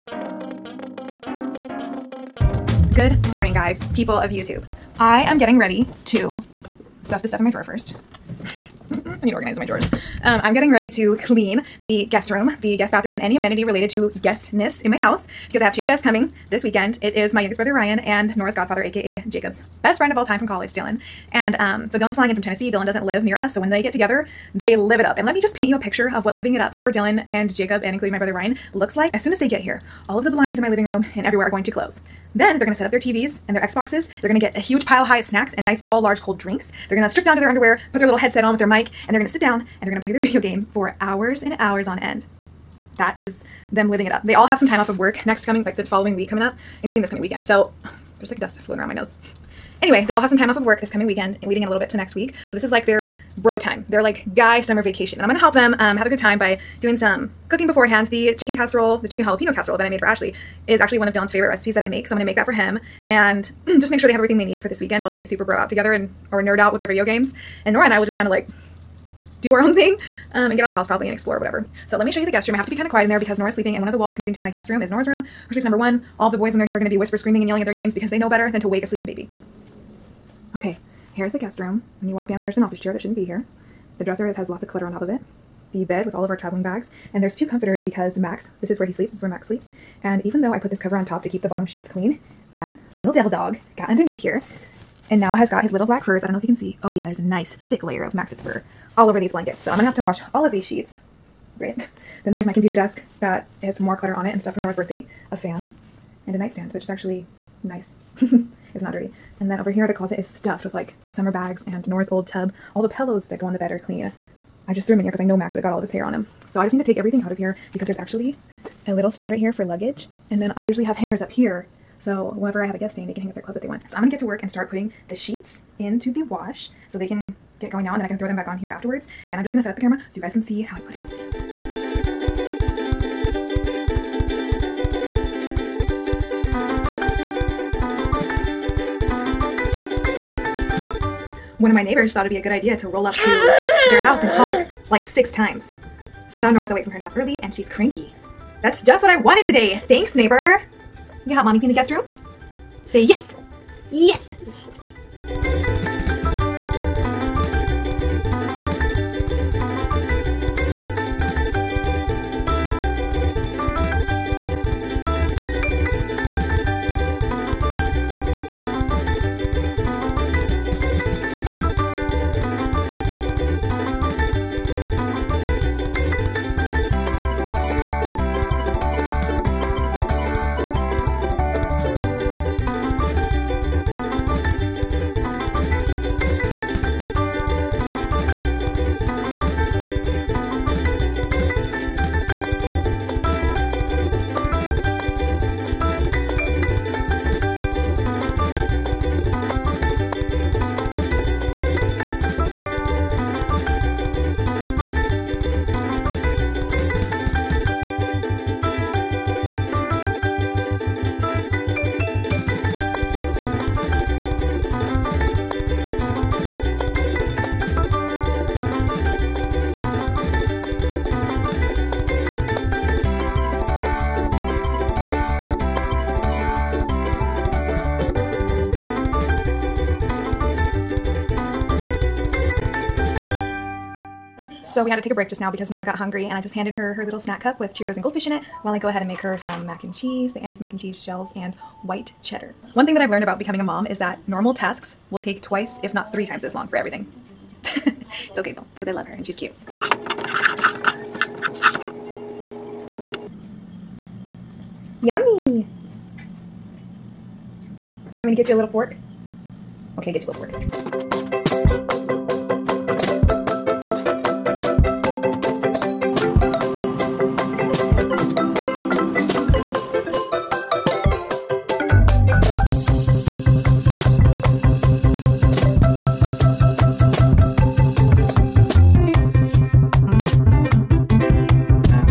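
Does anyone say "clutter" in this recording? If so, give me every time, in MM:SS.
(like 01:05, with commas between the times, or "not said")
01:24, 01:43.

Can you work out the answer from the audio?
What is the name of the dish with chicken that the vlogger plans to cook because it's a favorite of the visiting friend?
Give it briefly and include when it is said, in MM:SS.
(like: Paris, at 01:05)
chicken jalapeno casserole, at 00:59.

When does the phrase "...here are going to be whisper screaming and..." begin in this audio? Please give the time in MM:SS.
01:16.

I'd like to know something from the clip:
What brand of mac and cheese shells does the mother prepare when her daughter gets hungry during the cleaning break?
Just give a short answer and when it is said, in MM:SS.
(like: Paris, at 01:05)
Annie's, at 04:00.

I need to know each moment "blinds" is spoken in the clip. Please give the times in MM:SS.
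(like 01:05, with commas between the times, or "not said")
00:30.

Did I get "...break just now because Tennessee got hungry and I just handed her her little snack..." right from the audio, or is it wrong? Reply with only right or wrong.
wrong.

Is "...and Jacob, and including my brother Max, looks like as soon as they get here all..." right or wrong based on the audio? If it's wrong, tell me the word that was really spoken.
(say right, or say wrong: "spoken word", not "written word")
wrong: "Ryan", not "Max".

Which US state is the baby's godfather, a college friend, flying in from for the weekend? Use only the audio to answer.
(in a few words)
Tennessee.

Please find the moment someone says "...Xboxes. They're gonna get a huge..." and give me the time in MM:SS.
00:33.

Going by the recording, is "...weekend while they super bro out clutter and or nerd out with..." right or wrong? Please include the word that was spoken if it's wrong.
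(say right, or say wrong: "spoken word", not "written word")
wrong: "together", not "clutter".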